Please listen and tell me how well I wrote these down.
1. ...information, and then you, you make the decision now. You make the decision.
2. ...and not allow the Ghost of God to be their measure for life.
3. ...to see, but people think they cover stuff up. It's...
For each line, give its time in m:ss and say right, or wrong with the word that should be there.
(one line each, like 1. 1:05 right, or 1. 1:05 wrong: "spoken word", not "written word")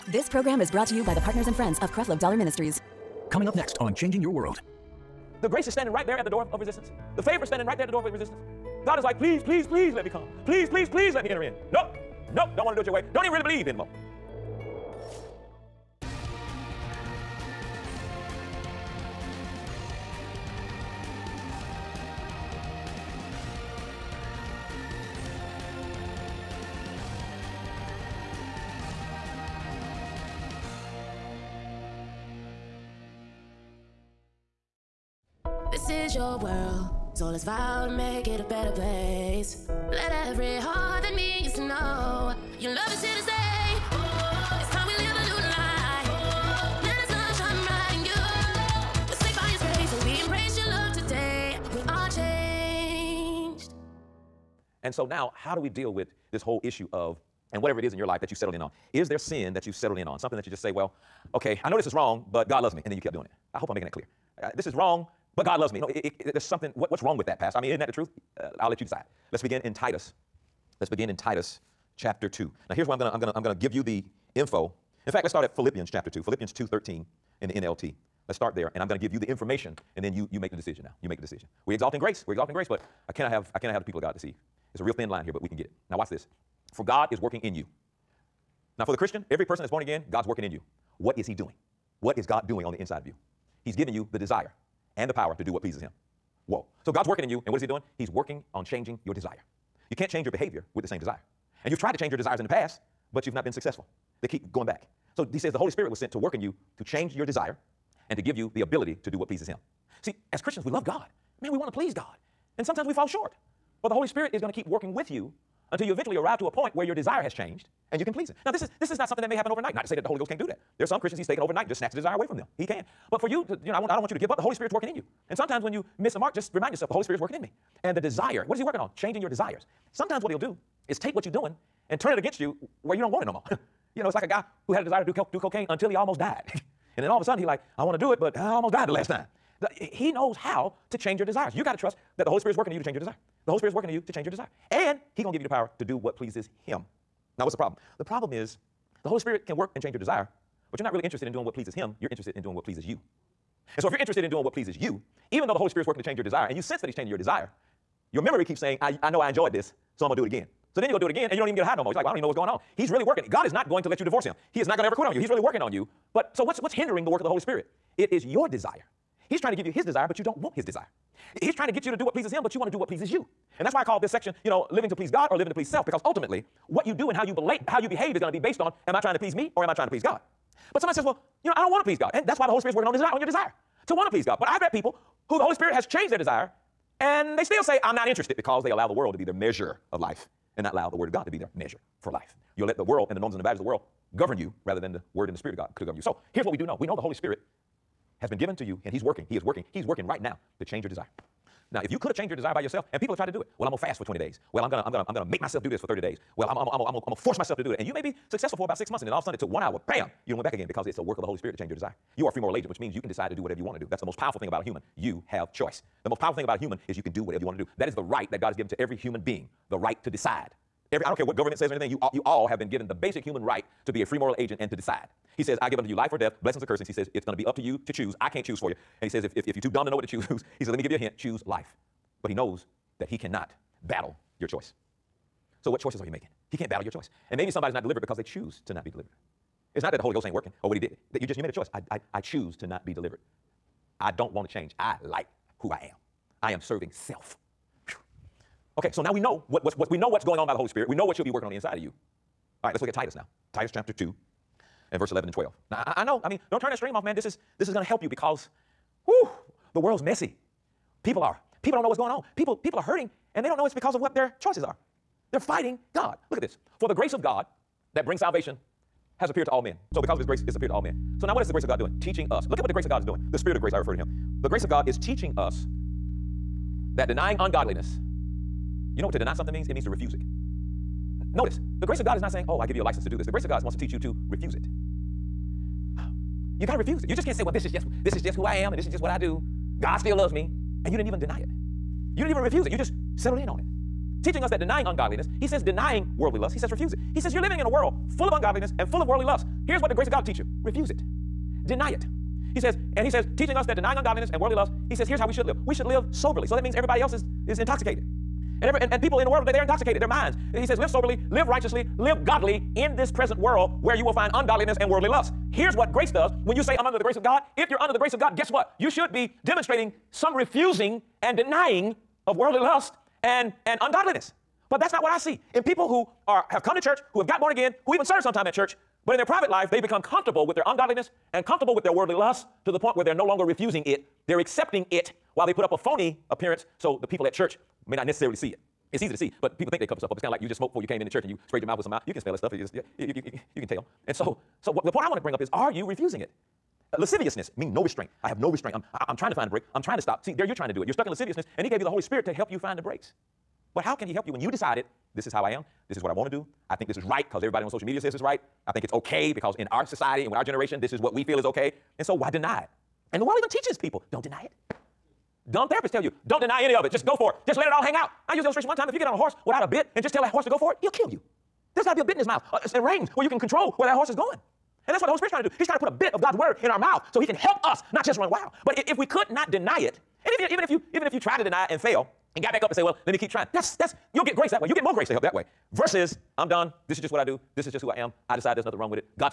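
1. 1:19 right
2. 3:10 wrong: "Word", not "Ghost"
3. 5:39 right.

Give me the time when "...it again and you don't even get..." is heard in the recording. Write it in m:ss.
2:41.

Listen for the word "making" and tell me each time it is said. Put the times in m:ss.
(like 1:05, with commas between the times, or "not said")
1:03, 3:56.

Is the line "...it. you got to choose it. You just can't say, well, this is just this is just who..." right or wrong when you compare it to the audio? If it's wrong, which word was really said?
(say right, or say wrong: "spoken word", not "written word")
wrong: "refuse", not "choose".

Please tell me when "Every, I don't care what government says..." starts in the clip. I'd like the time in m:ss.
3:40.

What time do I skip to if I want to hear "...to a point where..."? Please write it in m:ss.
1:56.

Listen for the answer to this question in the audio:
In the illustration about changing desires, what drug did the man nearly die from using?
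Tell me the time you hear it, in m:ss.
2:15.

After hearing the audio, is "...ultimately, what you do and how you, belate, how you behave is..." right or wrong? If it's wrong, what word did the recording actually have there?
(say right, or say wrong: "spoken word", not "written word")
right.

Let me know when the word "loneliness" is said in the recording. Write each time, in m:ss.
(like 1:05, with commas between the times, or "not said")
not said.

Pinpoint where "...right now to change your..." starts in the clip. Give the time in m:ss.
3:20.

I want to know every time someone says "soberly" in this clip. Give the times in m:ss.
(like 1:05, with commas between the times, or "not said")
5:06, 5:10.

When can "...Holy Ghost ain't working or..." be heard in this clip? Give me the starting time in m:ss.
4:00.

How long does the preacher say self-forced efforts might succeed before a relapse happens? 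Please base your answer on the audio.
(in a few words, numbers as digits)
Six months.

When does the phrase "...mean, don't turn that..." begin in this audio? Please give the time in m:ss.
4:16.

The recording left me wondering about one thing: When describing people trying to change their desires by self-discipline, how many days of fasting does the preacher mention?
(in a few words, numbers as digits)
20.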